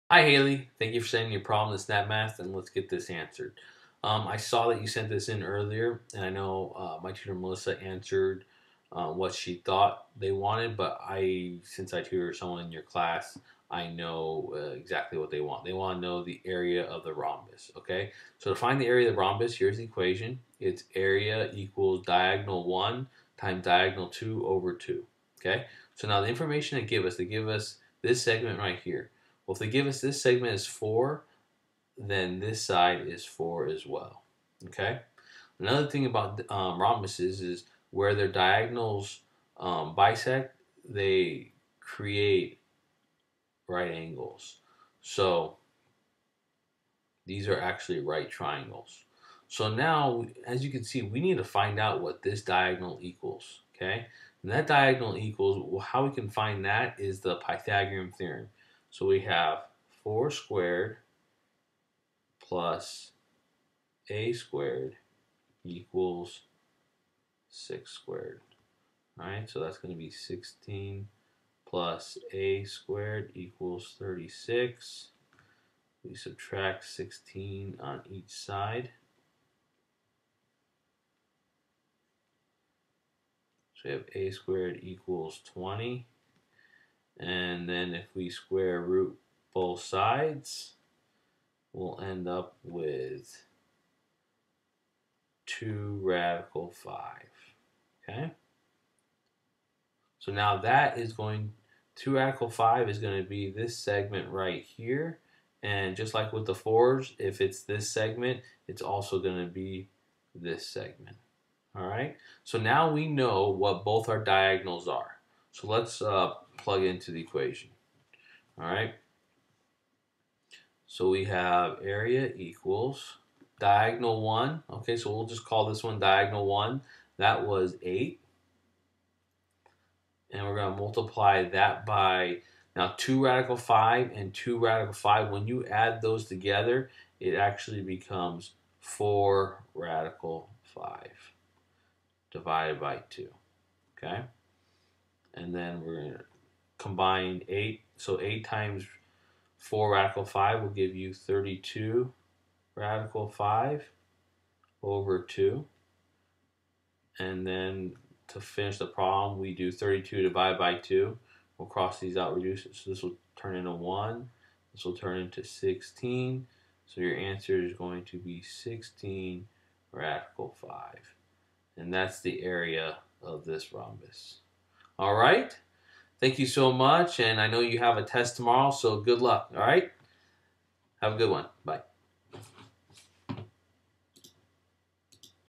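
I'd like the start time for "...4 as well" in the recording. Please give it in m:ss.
0:33.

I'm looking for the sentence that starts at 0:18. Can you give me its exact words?
So to find the area of the rhombus, here's the equation.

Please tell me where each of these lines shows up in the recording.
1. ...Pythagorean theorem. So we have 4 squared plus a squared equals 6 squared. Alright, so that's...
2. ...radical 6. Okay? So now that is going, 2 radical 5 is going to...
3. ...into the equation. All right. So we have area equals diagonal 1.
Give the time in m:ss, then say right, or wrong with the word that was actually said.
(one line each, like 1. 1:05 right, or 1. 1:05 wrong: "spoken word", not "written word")
1. 0:57 right
2. 1:36 wrong: "5", not "6"
3. 1:56 right.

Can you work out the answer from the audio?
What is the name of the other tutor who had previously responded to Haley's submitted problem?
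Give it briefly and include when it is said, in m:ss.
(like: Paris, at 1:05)
Melissa, at 0:07.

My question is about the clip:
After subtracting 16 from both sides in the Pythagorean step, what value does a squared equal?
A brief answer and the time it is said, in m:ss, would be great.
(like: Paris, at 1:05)
20, at 1:25.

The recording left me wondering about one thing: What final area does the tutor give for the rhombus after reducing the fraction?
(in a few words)
16 radical 5.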